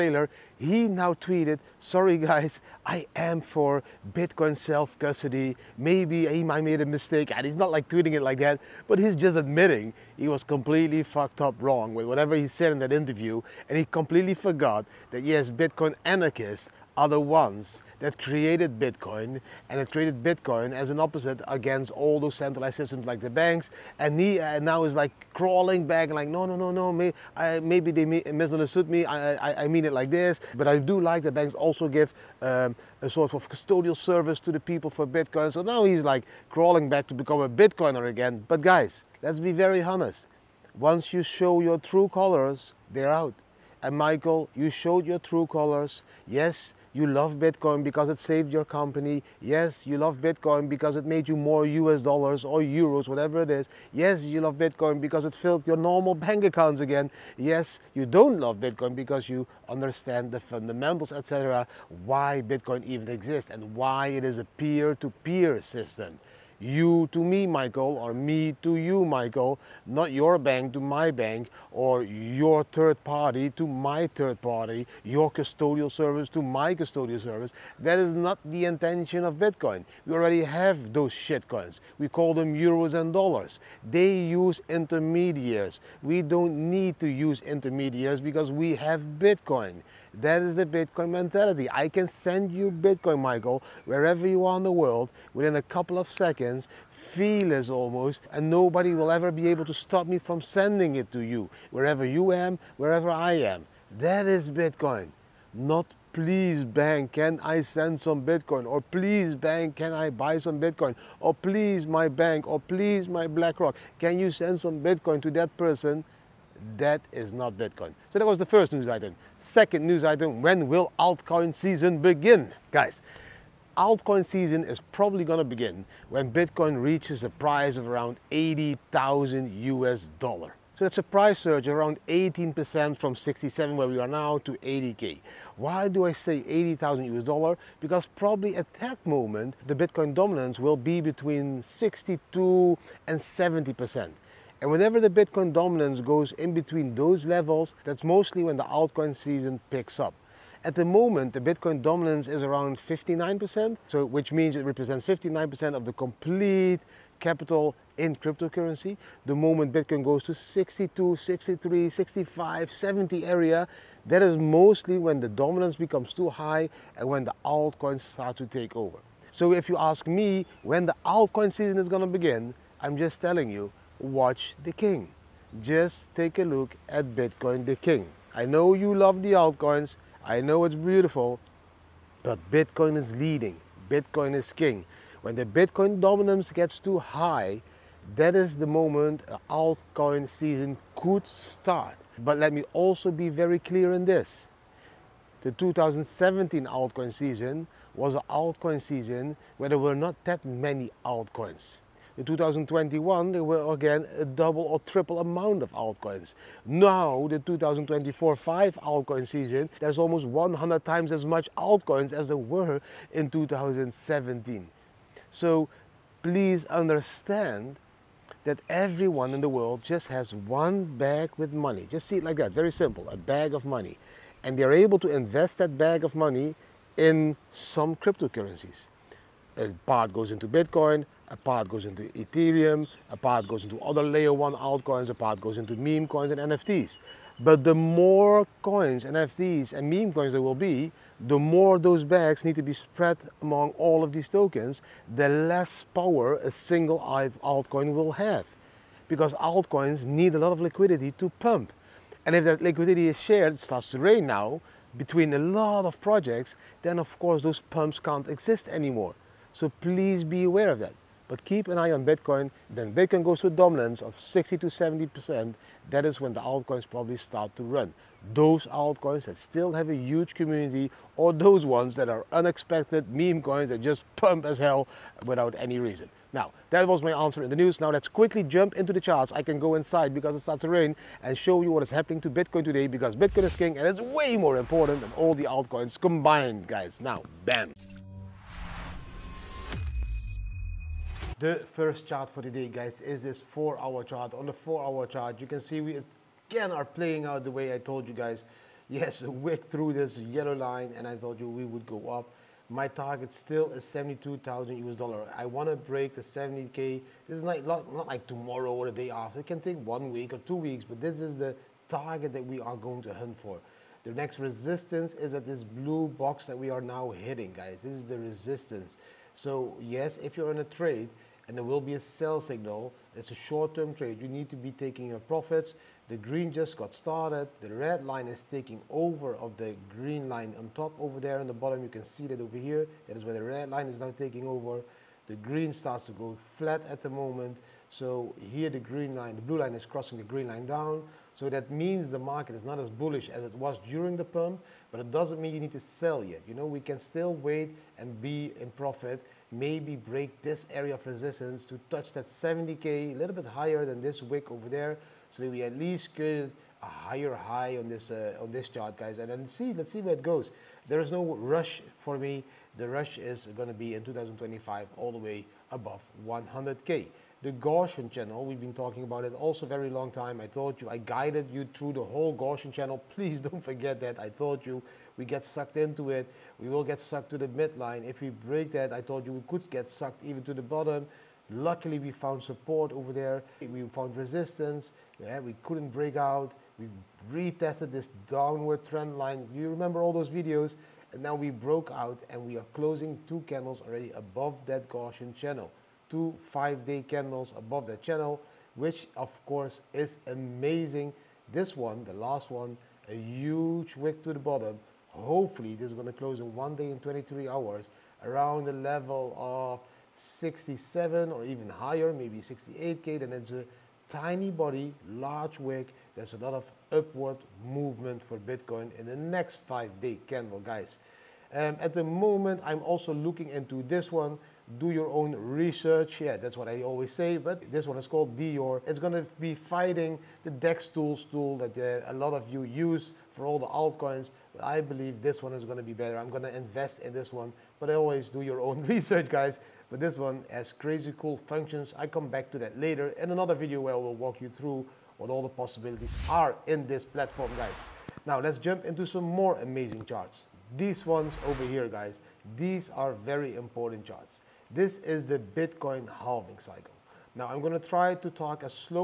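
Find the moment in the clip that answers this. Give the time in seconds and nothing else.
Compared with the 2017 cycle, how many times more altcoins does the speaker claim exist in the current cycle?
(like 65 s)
210 s.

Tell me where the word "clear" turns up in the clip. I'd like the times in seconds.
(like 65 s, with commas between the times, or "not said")
193 s.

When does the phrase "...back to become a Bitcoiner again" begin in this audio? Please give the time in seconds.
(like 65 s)
36 s.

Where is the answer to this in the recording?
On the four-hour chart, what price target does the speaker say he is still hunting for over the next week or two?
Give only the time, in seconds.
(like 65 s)
303 s.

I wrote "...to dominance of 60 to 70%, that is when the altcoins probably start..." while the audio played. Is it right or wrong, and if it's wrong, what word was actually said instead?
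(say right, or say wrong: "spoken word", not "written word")
right.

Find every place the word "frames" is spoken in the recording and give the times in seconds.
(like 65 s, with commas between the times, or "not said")
not said.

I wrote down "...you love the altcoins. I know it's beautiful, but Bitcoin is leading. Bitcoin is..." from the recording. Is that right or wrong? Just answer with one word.
right.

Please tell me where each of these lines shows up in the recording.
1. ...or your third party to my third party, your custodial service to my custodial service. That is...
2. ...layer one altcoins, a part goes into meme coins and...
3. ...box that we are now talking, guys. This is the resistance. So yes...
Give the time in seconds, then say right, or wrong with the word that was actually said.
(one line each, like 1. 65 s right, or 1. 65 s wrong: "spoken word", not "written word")
1. 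71 s right
2. 234 s right
3. 316 s wrong: "hitting", not "talking".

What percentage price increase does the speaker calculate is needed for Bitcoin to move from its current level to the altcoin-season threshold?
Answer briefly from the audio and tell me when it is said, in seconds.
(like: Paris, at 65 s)
18%, at 132 s.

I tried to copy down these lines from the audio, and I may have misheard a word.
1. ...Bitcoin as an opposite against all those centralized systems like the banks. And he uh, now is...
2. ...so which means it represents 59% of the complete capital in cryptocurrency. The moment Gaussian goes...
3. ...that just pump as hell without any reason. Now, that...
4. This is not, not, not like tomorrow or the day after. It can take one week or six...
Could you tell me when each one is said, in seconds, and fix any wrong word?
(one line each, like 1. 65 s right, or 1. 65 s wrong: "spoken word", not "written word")
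1. 20 s right
2. 153 s wrong: "Bitcoin", not "Gaussian"
3. 273 s right
4. 307 s wrong: "two", not "six".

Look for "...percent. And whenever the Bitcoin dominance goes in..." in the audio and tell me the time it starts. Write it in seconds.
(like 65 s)
143 s.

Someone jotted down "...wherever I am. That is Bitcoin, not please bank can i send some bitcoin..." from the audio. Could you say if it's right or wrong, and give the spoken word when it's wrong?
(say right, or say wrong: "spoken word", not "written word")
right.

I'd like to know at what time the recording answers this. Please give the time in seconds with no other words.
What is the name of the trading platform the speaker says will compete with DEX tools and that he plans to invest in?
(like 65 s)
428 s.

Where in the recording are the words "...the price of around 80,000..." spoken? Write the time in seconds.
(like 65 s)
127 s.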